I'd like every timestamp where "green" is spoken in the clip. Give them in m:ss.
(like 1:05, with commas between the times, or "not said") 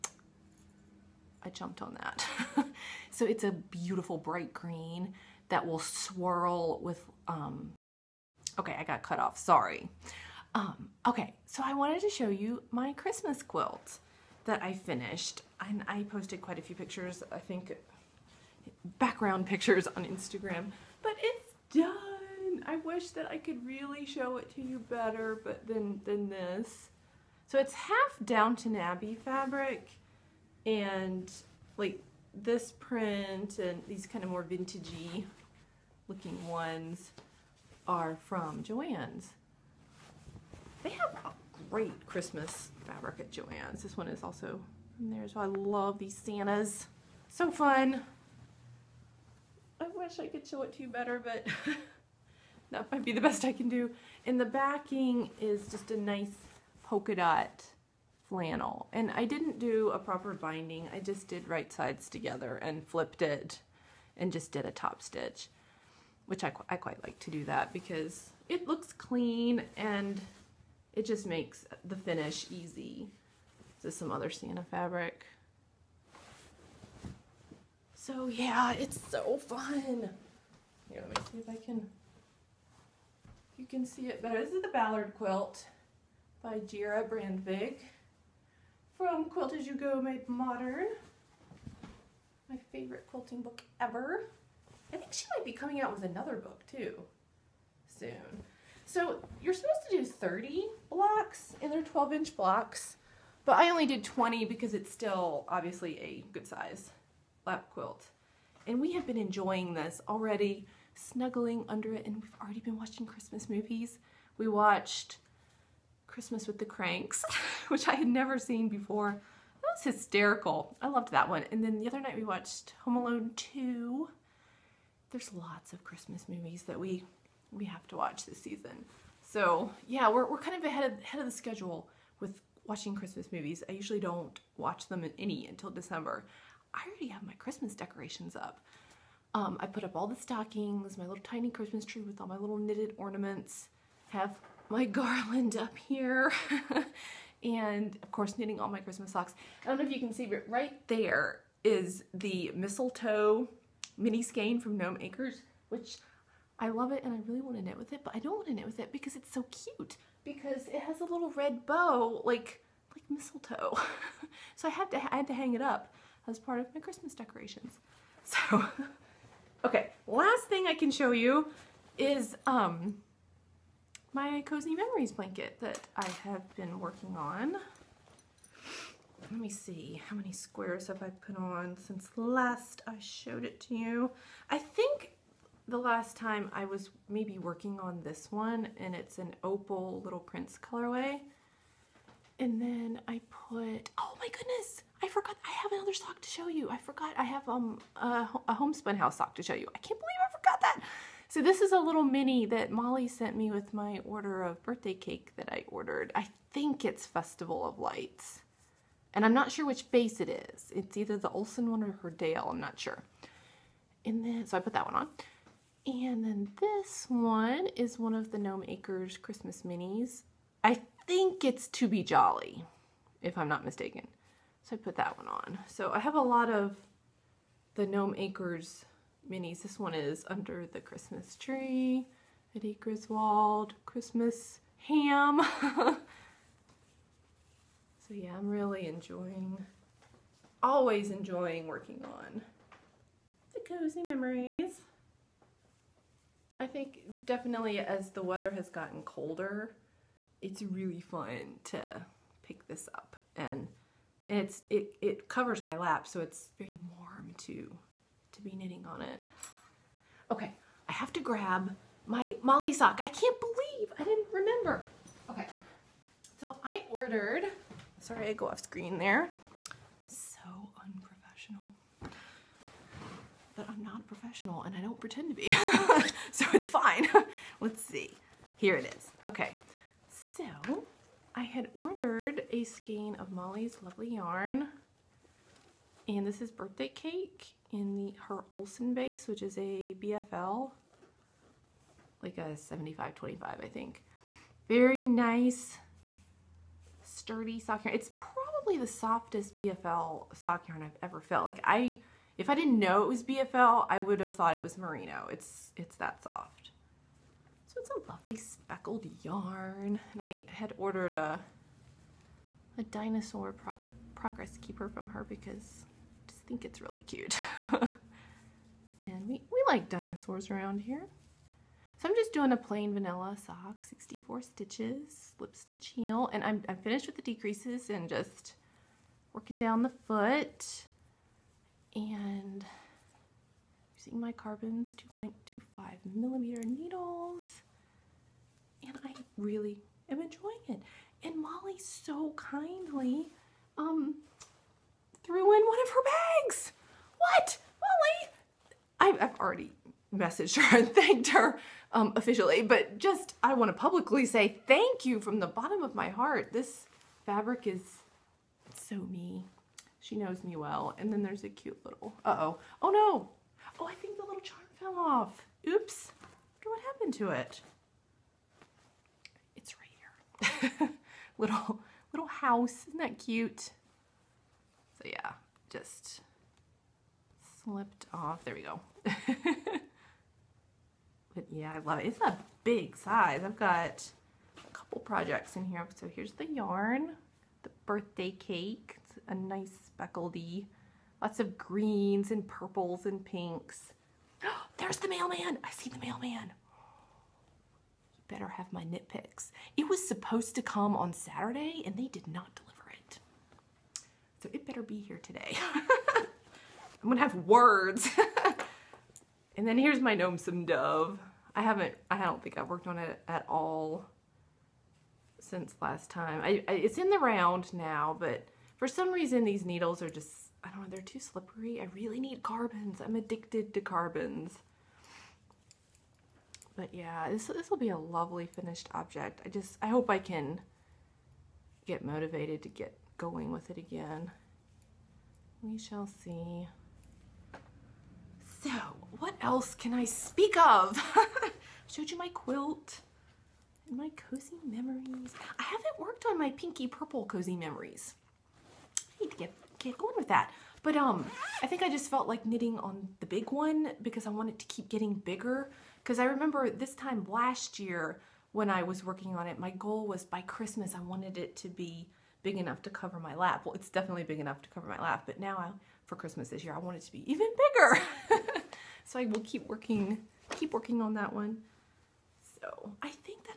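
0:04, 6:31.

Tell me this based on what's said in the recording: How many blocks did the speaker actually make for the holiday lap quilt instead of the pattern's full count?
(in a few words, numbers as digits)
20.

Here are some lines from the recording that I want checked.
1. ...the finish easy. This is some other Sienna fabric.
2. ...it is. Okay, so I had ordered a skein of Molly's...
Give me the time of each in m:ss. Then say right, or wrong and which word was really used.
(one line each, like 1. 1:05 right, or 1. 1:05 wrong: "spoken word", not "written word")
1. 1:11 right
2. 4:38 right.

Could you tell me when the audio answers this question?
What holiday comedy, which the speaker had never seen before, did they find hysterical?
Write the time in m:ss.
1:56.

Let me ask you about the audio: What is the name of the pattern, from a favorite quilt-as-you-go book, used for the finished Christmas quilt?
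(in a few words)
Ballard quilt.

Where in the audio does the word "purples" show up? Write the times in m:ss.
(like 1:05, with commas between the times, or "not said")
6:32, 7:26.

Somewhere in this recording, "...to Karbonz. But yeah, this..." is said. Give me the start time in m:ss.
7:03.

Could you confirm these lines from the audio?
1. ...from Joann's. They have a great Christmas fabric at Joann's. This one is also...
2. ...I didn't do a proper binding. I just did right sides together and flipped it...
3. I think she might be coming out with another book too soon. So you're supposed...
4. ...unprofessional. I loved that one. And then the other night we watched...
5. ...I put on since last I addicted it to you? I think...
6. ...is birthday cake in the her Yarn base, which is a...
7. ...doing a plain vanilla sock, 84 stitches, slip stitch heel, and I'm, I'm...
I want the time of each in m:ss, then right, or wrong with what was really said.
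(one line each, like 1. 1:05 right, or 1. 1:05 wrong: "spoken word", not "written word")
1. 0:38 right
2. 0:59 right
3. 1:34 right
4. 1:59 wrong: "hysterical", not "unprofessional"
5. 3:01 wrong: "showed", not "addicted"
6. 4:46 wrong: "Olsen", not "Yarn"
7. 5:22 wrong: "64", not "84".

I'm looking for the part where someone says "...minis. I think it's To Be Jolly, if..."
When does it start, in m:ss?
3:39.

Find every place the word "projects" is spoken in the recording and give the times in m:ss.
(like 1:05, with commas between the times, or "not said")
6:25.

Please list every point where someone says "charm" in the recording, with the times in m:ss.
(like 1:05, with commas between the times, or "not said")
6:04.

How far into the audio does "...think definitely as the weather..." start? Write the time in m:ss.
4:06.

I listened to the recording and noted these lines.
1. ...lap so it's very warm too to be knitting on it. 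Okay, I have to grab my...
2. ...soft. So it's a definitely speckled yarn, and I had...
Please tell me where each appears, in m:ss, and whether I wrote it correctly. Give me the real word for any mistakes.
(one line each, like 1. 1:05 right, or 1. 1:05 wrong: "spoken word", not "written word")
1. 4:15 right
2. 5:06 wrong: "lovely", not "definitely".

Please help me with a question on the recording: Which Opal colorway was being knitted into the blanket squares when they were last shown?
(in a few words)
little prince.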